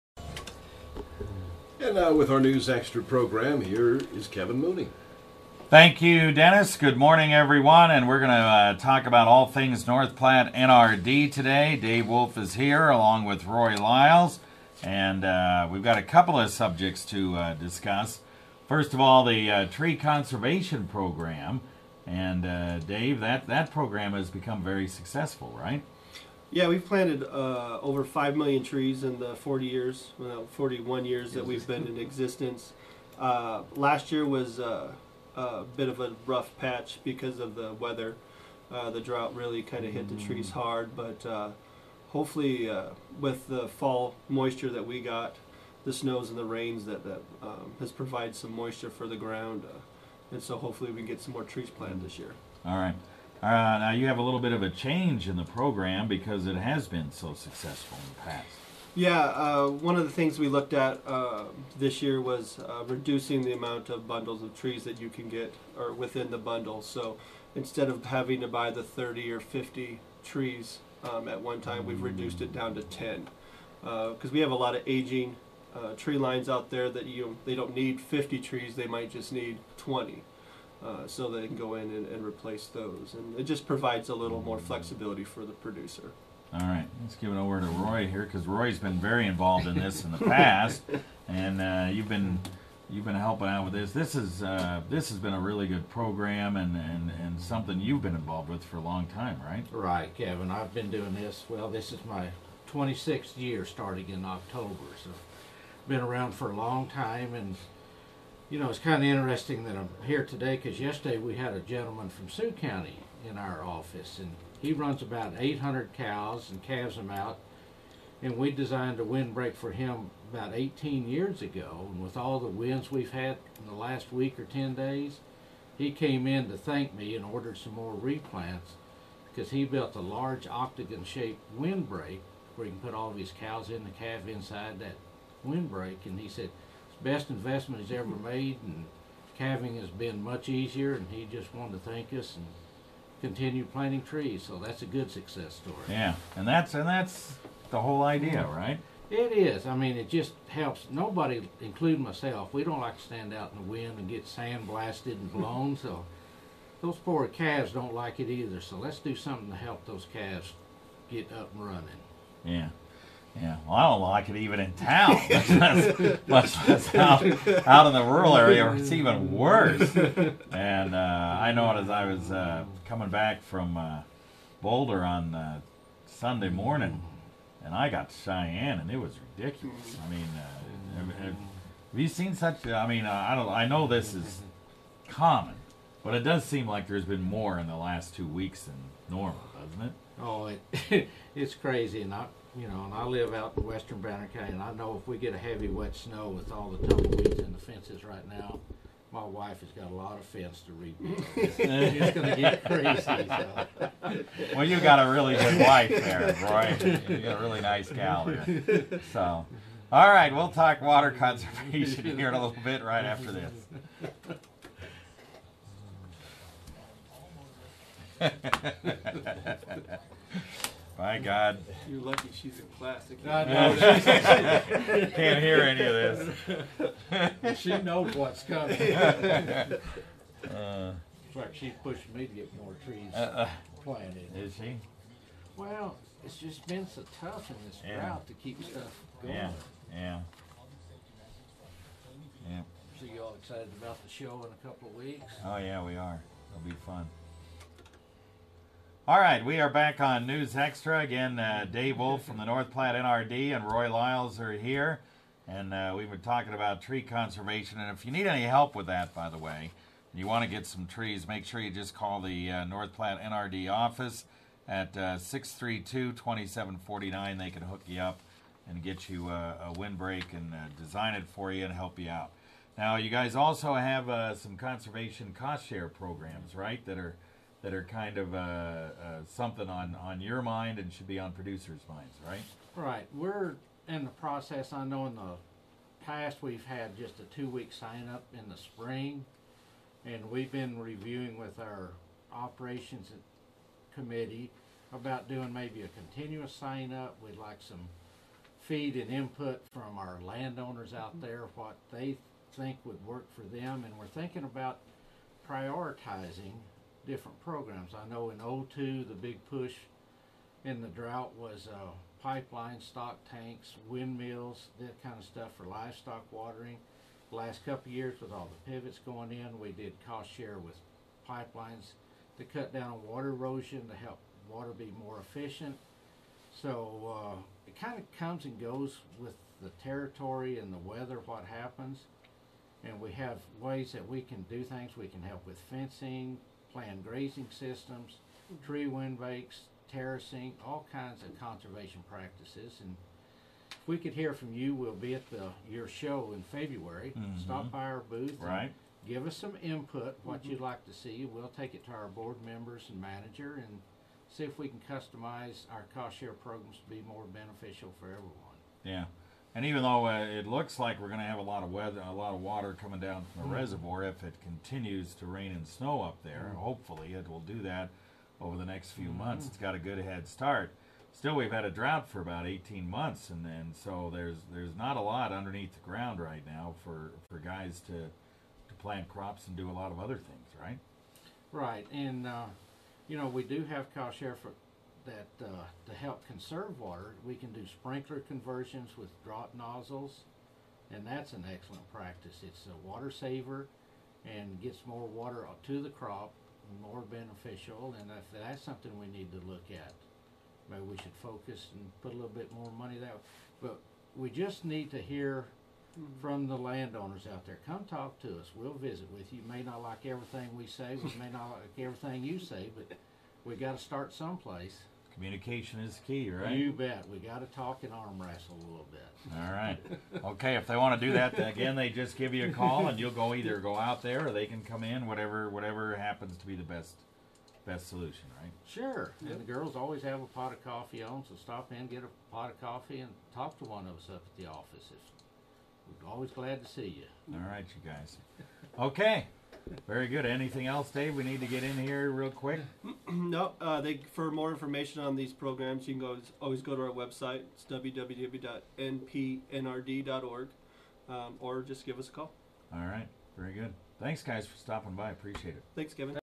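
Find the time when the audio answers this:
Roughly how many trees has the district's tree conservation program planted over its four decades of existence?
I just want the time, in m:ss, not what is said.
0:27.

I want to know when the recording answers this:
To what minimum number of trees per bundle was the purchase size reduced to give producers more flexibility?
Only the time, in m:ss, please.
1:12.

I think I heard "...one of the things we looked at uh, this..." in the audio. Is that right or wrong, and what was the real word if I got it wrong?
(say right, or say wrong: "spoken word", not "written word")
right.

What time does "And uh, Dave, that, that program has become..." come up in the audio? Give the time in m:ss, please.
0:22.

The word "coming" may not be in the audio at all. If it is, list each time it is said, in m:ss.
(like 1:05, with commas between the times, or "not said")
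2:52, 3:48, 6:02.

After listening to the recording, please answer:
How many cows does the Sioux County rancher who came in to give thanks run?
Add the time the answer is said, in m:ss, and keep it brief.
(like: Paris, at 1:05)
800, at 1:55.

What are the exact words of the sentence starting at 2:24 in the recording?
So that's a good success story.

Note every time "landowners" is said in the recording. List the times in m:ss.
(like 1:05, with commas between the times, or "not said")
5:00, 6:46.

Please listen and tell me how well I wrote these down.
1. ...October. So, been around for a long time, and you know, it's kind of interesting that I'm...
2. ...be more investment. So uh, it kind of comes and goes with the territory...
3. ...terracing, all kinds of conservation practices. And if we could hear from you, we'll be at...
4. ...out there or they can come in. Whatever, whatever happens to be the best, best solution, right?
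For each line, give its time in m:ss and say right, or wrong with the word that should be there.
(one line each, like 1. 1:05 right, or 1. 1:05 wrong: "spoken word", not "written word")
1. 1:44 right
2. 5:24 wrong: "efficient", not "investment"
3. 5:39 right
4. 7:03 right.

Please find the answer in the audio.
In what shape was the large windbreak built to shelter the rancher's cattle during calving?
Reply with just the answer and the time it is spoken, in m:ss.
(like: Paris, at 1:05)
octagon, at 2:10.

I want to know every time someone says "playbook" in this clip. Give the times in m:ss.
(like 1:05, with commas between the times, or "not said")
not said.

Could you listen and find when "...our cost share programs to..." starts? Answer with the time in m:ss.
5:55.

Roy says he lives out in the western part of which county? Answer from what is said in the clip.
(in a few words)
Banner County.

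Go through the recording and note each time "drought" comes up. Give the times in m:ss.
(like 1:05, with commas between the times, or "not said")
0:38, 3:57, 5:10, 6:11.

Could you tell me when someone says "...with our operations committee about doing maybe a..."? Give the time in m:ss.
4:51.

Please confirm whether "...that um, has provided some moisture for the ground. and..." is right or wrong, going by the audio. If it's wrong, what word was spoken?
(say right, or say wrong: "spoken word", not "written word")
right.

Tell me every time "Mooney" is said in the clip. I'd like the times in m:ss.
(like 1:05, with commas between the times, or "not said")
0:04.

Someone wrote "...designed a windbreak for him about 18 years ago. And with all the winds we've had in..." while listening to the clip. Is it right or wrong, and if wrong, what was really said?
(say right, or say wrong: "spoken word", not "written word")
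right.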